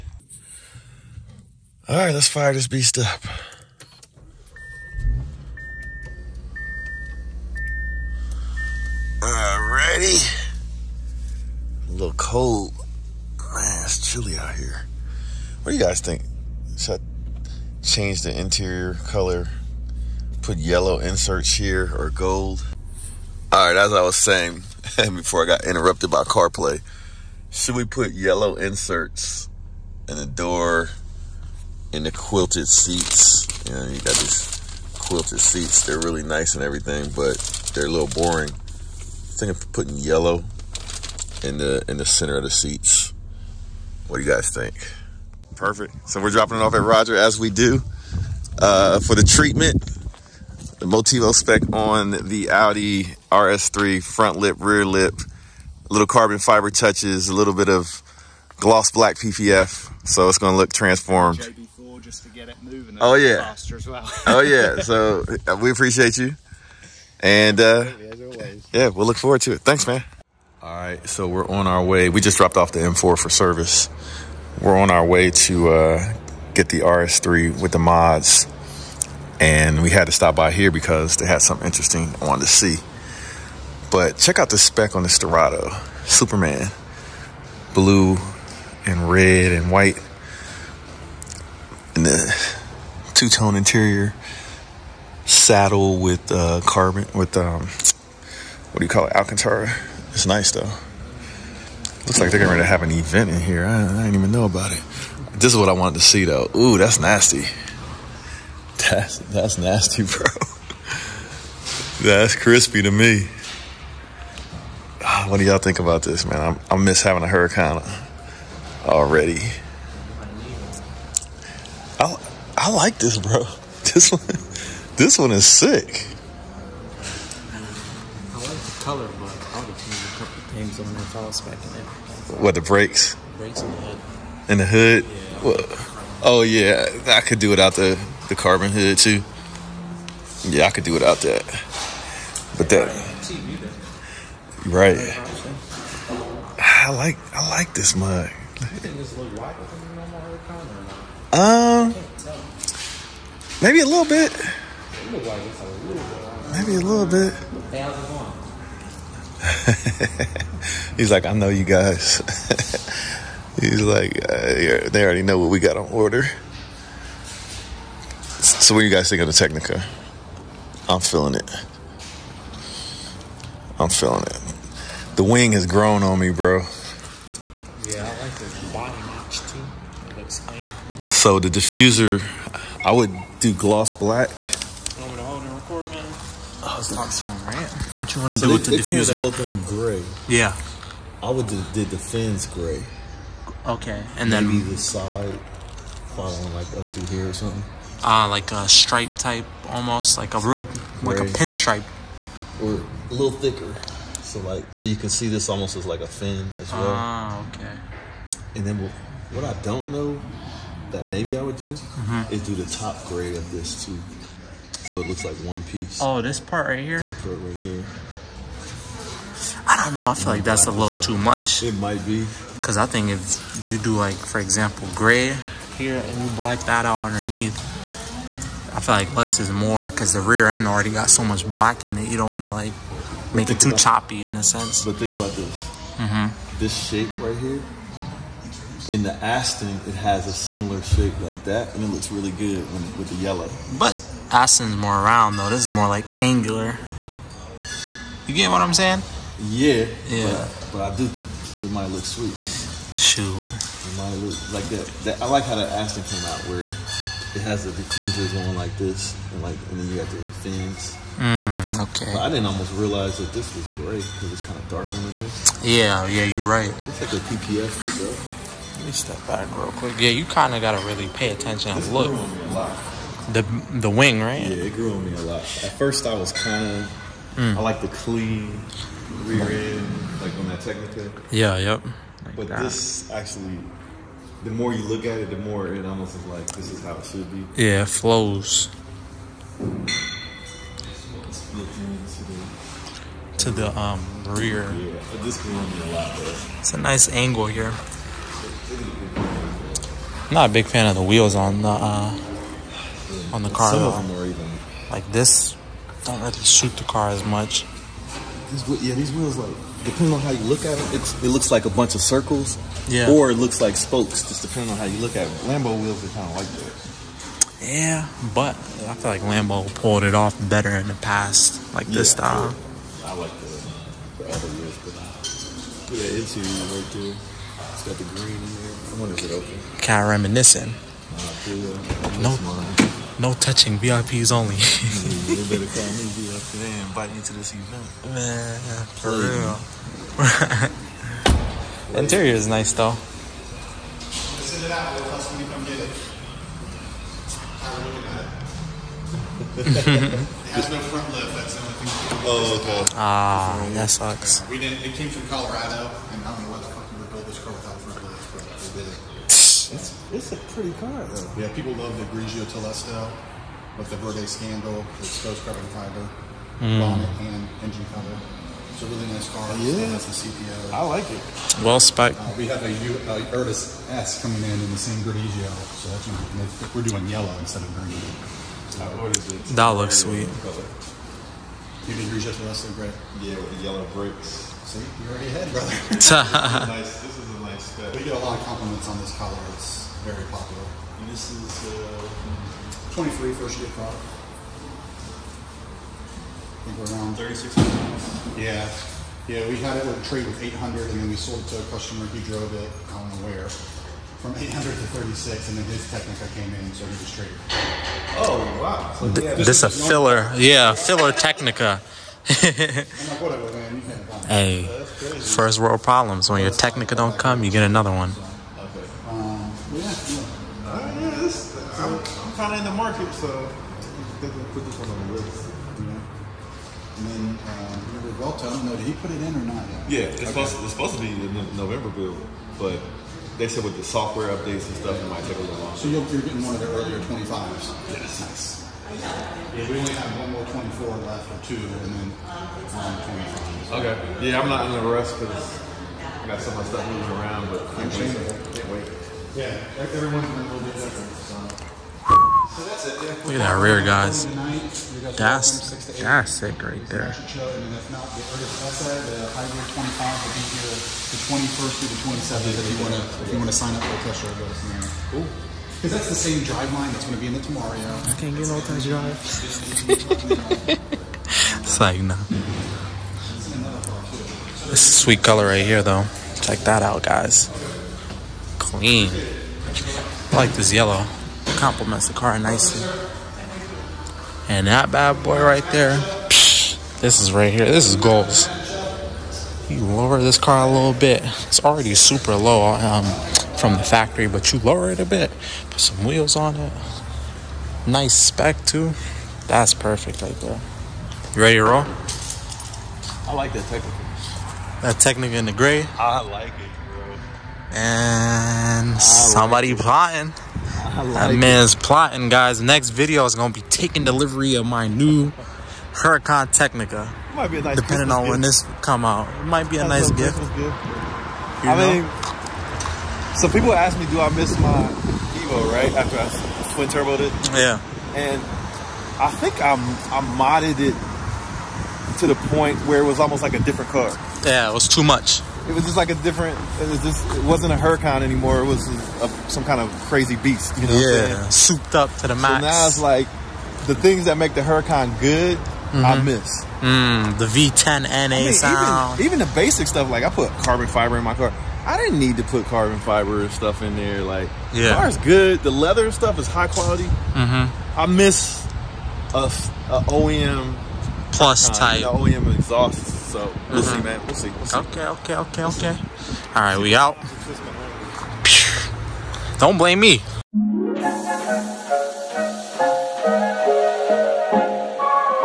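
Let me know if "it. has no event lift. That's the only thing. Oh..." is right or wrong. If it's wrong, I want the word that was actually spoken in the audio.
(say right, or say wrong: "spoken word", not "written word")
wrong: "front", not "event".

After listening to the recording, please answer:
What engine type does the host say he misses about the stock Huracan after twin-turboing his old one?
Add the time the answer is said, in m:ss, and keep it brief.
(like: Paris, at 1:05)
V10 NA, at 9:07.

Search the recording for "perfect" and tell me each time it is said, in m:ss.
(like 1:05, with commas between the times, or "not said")
0:45, 8:19.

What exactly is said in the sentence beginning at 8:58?
It was a, some kind of crazy beast.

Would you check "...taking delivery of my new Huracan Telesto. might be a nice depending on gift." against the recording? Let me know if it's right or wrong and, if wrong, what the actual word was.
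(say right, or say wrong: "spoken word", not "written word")
wrong: "Tecnica", not "Telesto".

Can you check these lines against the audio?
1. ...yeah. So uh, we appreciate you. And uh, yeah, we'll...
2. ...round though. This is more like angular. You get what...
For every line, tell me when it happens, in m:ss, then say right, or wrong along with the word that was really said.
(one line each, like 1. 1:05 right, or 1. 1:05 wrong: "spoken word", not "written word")
1. 1:04 right
2. 4:05 right.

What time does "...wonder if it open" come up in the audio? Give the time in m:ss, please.
5:29.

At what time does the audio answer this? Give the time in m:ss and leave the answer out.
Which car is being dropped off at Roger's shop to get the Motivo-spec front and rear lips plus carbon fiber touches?
0:52.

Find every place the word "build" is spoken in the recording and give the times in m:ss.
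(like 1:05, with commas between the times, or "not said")
5:57, 7:11.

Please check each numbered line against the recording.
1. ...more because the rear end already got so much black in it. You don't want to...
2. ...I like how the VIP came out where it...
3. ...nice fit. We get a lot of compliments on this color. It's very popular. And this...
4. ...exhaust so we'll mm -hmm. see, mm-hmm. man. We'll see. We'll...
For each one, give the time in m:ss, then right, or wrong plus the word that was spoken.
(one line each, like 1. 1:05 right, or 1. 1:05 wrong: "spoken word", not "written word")
1. 3:49 right
2. 4:15 wrong: "Aston", not "VIP"
3. 6:27 right
4. 9:22 right.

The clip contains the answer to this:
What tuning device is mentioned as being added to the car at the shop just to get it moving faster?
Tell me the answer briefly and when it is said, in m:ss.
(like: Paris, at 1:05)
JB4, at 1:01.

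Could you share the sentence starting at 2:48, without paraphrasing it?
So, what do you guys think of the Tecnica?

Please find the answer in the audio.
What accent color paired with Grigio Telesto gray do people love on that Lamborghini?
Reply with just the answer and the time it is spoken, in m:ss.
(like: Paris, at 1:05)
Verde Scandal, at 6:03.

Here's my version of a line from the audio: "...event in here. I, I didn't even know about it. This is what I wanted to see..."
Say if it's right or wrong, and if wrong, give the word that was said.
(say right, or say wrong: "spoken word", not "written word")
right.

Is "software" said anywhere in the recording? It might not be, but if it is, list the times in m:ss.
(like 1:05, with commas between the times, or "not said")
7:13.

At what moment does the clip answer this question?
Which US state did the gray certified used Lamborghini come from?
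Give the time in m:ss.
5:55.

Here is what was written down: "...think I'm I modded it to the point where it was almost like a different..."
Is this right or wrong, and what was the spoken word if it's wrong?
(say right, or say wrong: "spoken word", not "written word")
right.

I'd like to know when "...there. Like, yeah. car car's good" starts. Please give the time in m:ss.
9:13.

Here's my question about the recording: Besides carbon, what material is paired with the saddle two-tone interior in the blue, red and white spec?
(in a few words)
Alcantara.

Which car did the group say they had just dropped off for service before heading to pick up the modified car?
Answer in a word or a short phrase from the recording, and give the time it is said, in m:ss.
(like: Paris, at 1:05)
M4, at 1:12.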